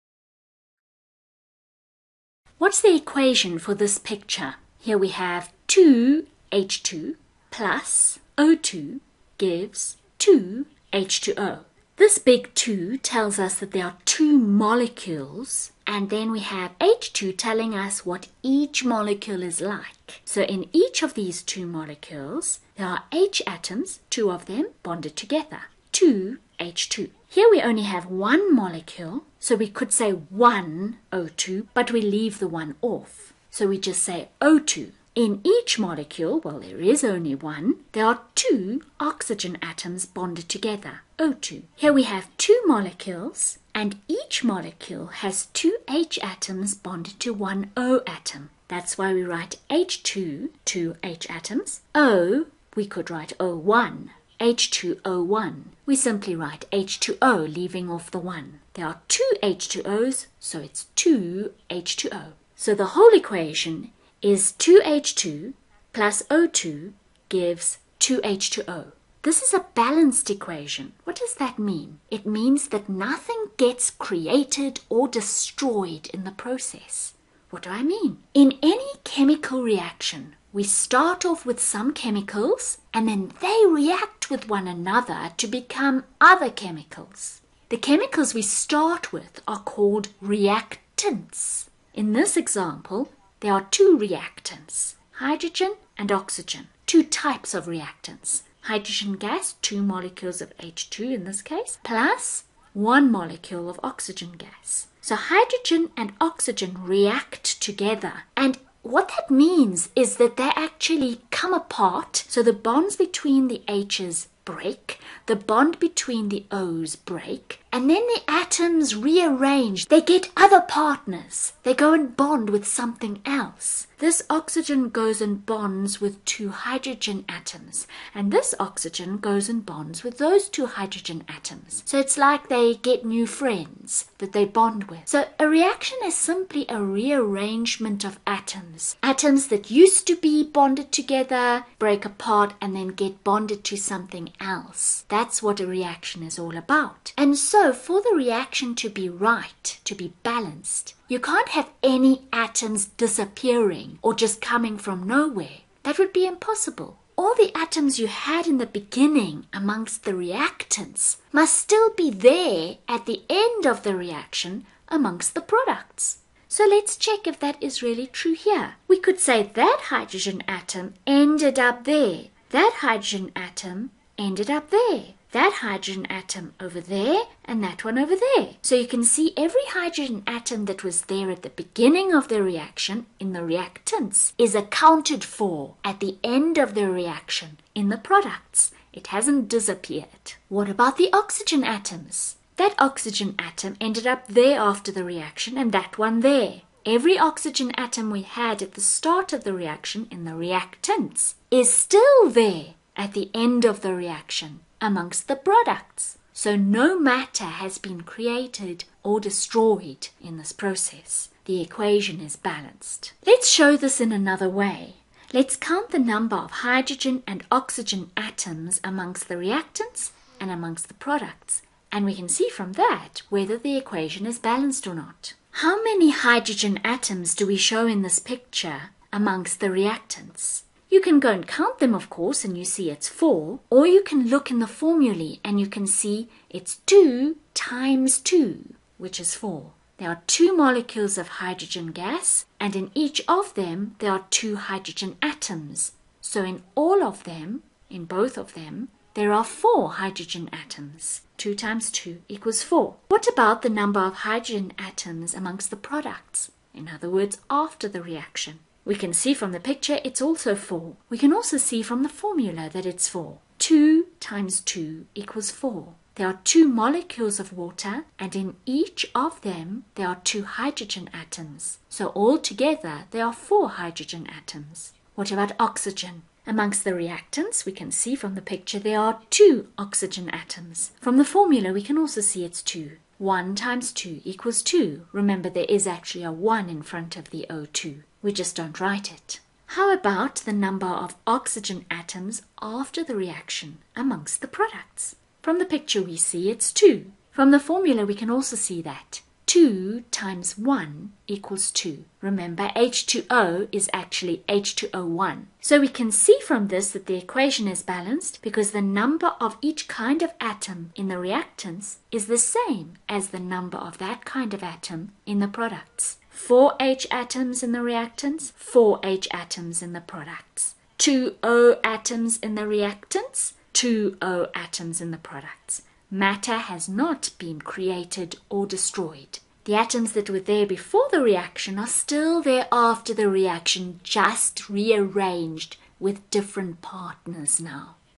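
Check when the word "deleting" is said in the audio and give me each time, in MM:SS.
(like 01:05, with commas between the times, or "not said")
not said.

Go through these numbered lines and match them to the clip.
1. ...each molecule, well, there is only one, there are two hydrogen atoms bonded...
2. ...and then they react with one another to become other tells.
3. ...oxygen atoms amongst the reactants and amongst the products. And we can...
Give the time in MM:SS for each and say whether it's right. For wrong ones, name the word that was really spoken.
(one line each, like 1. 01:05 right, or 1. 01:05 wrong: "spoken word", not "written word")
1. 00:35 wrong: "oxygen", not "hydrogen"
2. 01:22 wrong: "chemicals", not "tells"
3. 03:37 right.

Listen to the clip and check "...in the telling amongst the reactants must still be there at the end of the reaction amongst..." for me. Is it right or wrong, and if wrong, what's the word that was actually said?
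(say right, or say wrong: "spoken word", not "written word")
wrong: "beginning", not "telling".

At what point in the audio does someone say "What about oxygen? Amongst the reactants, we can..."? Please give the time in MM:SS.
04:35.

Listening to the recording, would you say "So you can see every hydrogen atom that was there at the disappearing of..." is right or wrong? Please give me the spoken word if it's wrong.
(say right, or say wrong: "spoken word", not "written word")
wrong: "beginning", not "disappearing".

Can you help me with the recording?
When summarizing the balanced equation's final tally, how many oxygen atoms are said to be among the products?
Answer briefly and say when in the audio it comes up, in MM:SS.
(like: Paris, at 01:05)
2, at 05:23.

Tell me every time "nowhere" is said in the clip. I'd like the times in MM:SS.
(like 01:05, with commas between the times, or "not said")
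02:35.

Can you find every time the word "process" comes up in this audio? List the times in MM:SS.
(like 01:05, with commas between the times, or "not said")
01:16, 03:30.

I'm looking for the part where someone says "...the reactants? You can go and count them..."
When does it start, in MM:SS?
03:49.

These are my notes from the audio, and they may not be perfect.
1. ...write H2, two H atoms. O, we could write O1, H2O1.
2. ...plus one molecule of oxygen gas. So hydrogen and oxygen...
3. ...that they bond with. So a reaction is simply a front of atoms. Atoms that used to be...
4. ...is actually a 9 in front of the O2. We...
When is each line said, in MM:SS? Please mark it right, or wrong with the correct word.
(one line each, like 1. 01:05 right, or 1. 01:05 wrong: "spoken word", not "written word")
1. 00:49 right
2. 01:41 right
3. 02:14 wrong: "rearrangement", not "front"
4. 04:45 wrong: "1", not "9".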